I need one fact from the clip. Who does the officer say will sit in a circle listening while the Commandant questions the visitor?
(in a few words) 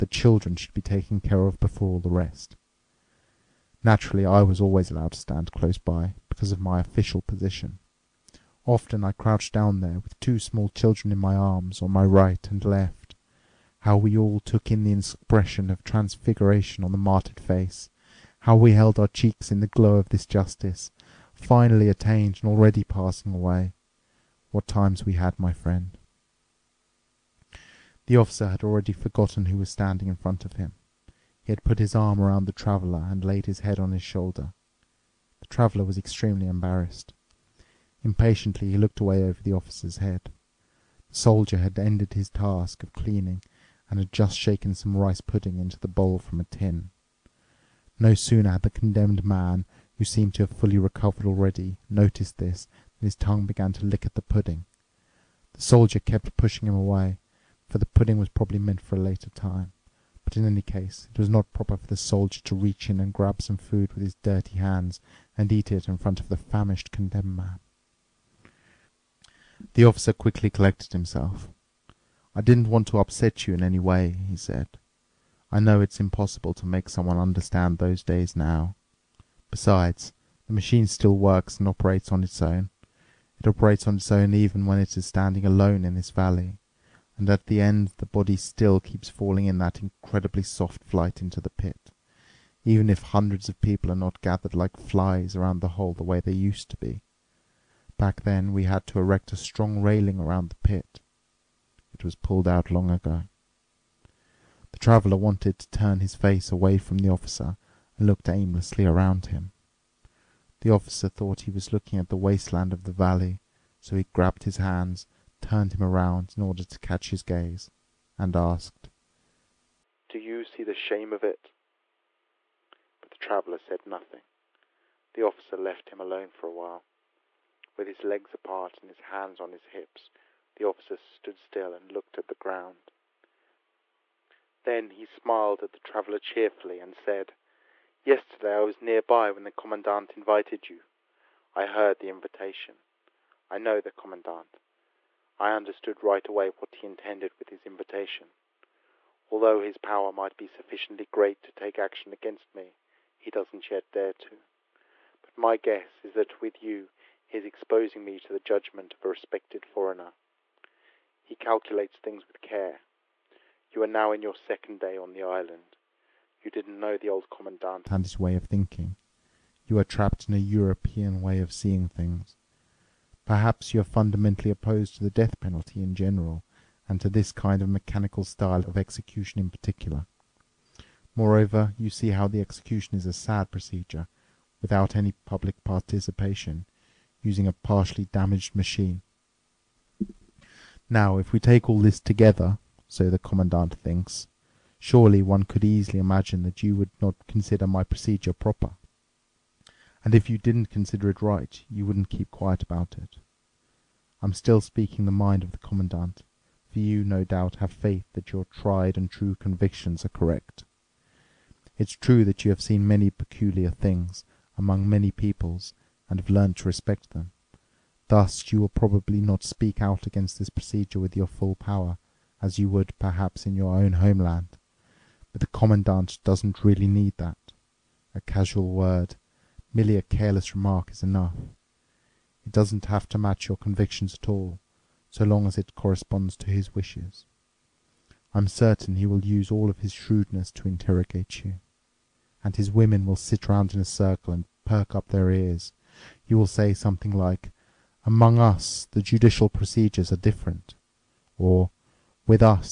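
His women.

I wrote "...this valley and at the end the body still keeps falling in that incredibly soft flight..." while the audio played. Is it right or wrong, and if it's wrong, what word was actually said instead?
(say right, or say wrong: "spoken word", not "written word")
right.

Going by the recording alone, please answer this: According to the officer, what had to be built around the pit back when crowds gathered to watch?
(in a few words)
A strong railing.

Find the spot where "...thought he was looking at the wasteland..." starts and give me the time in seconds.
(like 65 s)
111 s.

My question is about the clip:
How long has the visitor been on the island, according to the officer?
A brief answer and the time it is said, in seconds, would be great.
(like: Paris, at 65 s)
Second day, at 164 s.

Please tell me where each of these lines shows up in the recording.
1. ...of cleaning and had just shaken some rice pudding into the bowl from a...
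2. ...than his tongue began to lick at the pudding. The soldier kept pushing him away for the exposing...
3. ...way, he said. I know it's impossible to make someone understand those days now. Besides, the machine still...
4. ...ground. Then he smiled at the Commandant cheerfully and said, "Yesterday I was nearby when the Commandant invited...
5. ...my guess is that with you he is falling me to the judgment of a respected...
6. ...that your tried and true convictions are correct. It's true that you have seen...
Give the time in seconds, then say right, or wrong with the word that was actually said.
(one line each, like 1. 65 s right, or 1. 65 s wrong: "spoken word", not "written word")
1. 42 s right
2. 52 s wrong: "pudding", not "exposing"
3. 73 s right
4. 132 s wrong: "Traveler", not "Commandant"
5. 155 s wrong: "exposing", not "falling"
6. 208 s right.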